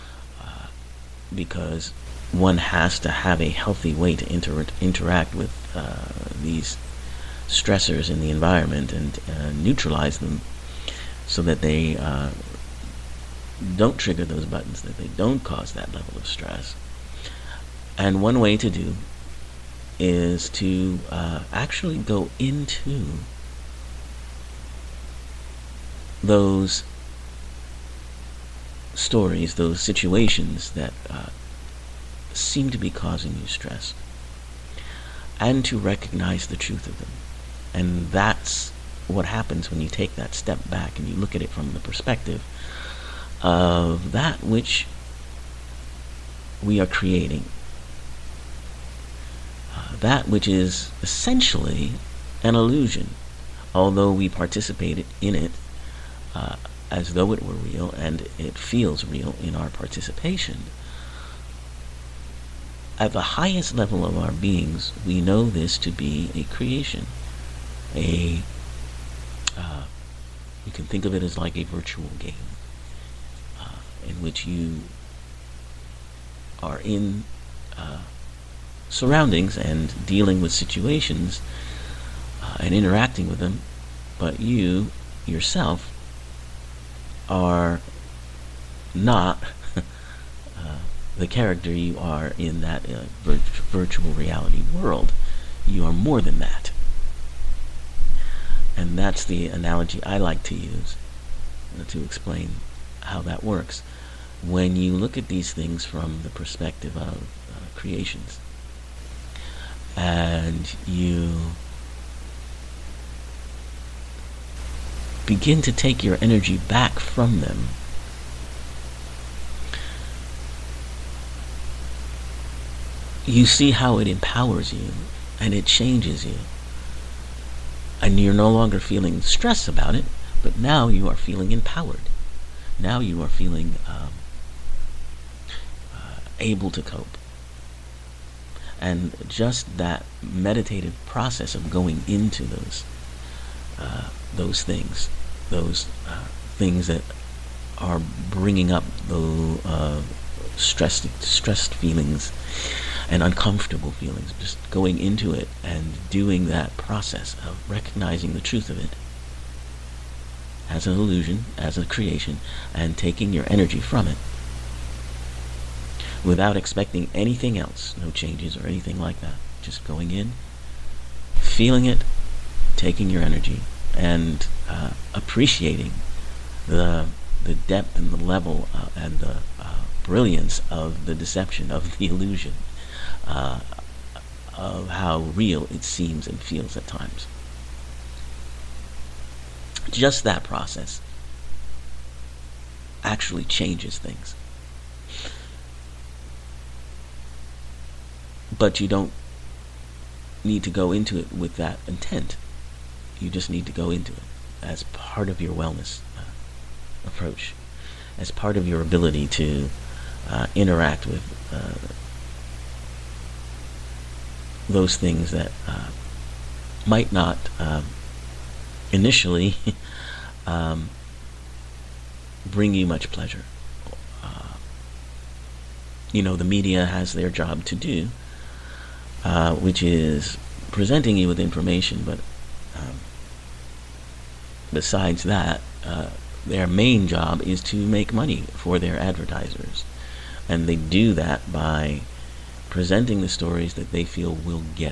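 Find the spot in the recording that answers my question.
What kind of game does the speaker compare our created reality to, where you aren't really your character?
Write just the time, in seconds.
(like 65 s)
71 s.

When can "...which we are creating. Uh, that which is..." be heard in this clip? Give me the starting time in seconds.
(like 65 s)
44 s.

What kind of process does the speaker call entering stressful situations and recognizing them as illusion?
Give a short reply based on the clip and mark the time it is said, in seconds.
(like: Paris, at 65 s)
meditative process, at 140 s.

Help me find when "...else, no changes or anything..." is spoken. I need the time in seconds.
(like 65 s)
167 s.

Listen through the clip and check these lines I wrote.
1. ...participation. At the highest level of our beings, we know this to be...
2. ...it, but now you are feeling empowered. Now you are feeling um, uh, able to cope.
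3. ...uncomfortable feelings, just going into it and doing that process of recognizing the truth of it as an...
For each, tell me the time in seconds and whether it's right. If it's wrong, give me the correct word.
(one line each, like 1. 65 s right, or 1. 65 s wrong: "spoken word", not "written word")
1. 59 s right
2. 129 s right
3. 153 s right.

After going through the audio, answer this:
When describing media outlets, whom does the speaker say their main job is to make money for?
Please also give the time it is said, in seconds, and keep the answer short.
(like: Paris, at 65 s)
their advertisers, at 238 s.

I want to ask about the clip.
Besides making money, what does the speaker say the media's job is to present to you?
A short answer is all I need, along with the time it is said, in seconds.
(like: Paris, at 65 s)
information, at 231 s.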